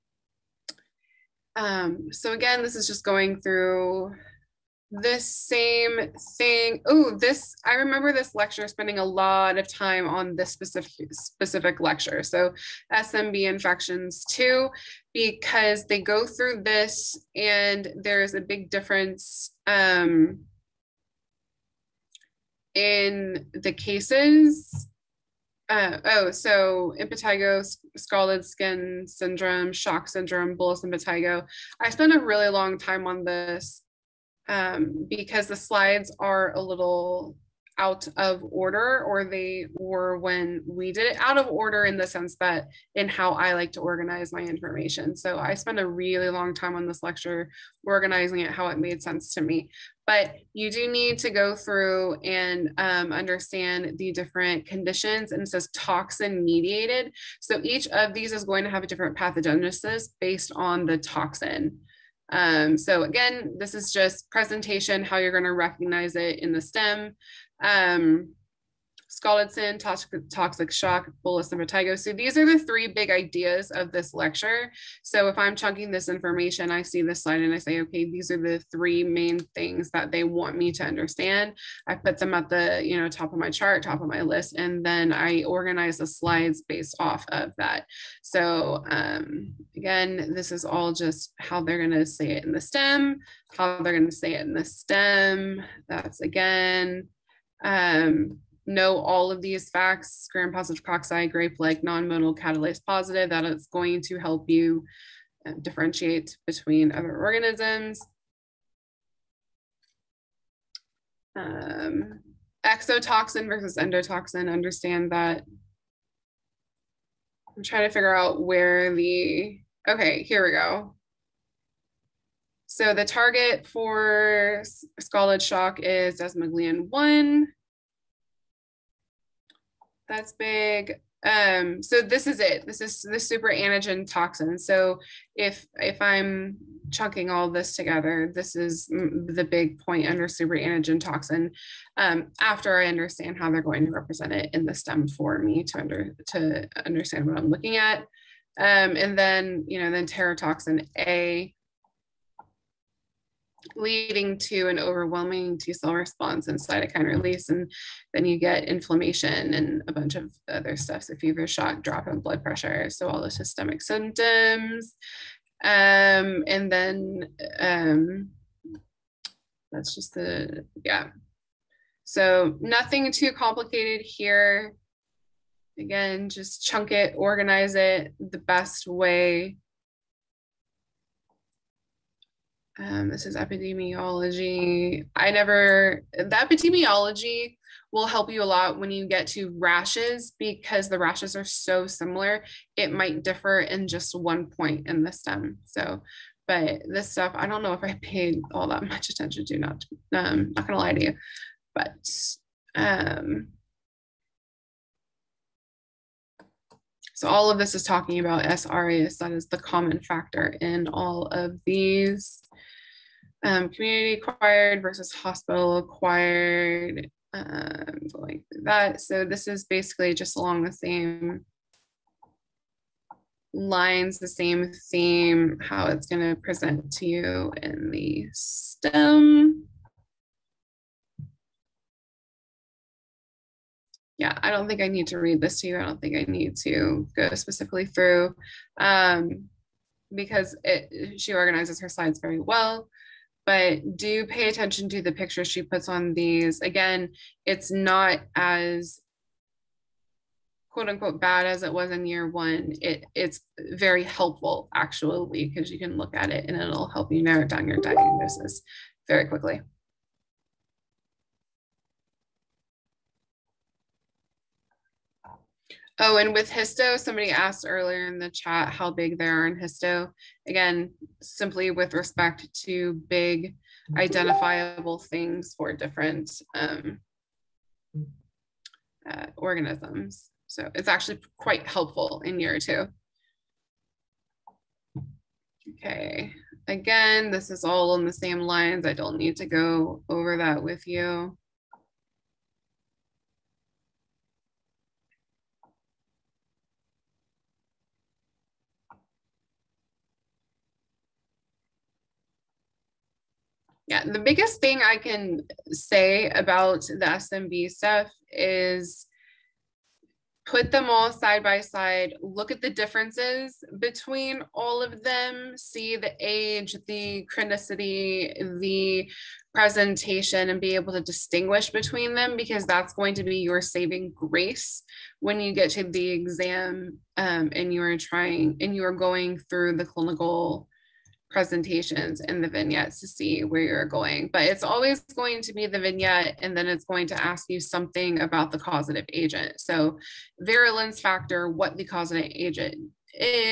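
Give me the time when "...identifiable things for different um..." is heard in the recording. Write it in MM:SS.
04:33.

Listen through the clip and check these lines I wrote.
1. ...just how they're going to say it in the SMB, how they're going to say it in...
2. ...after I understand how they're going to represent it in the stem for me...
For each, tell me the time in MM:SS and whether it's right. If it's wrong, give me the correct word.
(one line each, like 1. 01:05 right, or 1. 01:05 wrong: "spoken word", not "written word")
1. 01:30 wrong: "STEM", not "SMB"
2. 02:22 right.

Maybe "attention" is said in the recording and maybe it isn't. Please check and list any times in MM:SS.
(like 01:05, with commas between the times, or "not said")
03:19, 04:04.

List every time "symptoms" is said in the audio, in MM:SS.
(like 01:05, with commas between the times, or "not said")
02:43.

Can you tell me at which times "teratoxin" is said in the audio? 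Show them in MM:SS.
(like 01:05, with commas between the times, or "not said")
02:30.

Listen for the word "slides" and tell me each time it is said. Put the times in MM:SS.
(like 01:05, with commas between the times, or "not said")
00:35, 01:17, 01:26, 04:01.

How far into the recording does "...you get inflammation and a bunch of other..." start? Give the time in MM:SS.
02:38.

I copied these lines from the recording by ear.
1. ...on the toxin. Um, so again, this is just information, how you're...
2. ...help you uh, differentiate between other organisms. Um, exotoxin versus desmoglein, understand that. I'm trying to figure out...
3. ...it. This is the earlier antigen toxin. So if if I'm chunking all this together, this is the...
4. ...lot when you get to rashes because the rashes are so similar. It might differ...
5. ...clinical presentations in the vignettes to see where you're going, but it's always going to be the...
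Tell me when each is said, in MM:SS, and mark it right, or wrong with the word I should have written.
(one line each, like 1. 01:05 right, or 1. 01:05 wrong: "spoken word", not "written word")
1. 01:00 wrong: "presentation", not "information"
2. 01:44 wrong: "endotoxin", not "desmoglein"
3. 02:12 wrong: "super", not "earlier"
4. 03:08 right
5. 05:29 right.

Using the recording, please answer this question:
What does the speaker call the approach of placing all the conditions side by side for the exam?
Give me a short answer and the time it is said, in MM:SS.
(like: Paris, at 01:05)
Saving grace, at 05:23.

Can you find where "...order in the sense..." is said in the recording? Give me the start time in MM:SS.
00:41.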